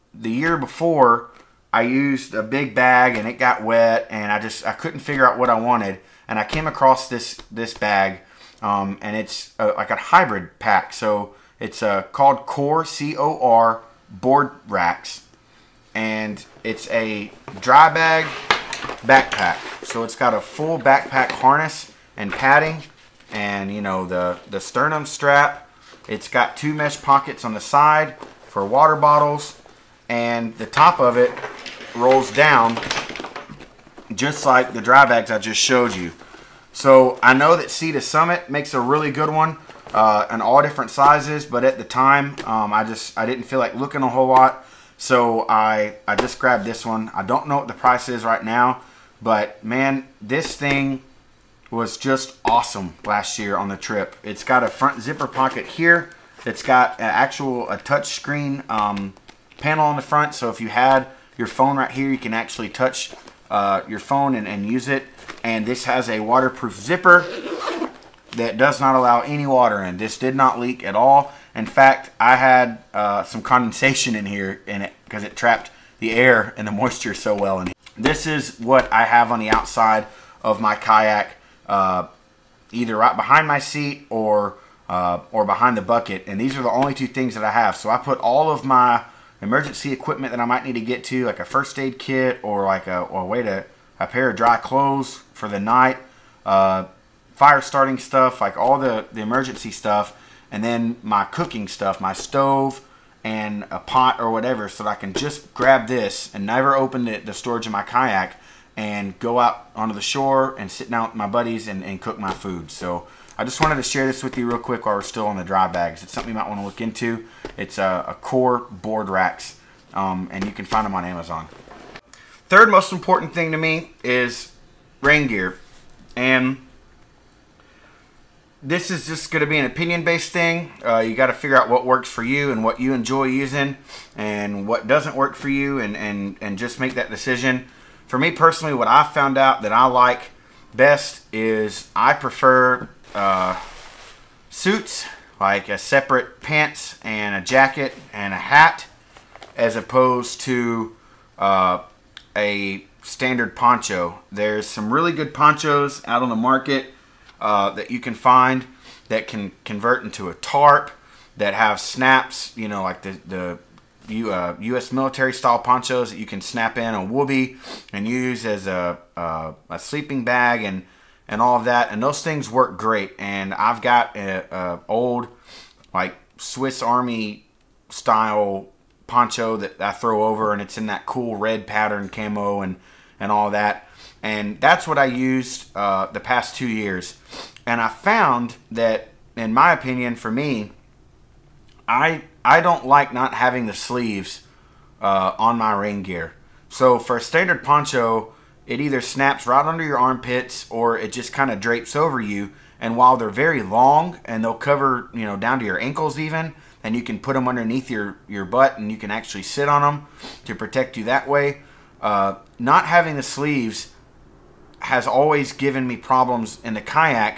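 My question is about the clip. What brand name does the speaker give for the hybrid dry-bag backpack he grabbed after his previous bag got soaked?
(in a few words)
Core board racks.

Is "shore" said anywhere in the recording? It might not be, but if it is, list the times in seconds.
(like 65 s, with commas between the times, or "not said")
110 s.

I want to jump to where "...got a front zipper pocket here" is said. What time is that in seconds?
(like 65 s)
54 s.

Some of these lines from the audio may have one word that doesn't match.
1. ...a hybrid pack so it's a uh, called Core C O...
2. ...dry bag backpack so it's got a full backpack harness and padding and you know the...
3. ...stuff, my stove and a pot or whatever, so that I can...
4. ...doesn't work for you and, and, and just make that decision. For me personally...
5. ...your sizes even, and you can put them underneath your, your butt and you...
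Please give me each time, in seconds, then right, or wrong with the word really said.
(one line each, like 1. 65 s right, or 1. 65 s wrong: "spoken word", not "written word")
1. 9 s right
2. 17 s right
3. 101 s right
4. 134 s right
5. 205 s wrong: "ankles", not "sizes".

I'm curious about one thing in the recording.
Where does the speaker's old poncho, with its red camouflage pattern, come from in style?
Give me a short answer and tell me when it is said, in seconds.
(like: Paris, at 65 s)
Swiss Army, at 176 s.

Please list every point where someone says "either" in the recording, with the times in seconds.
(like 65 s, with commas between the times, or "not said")
82 s, 198 s.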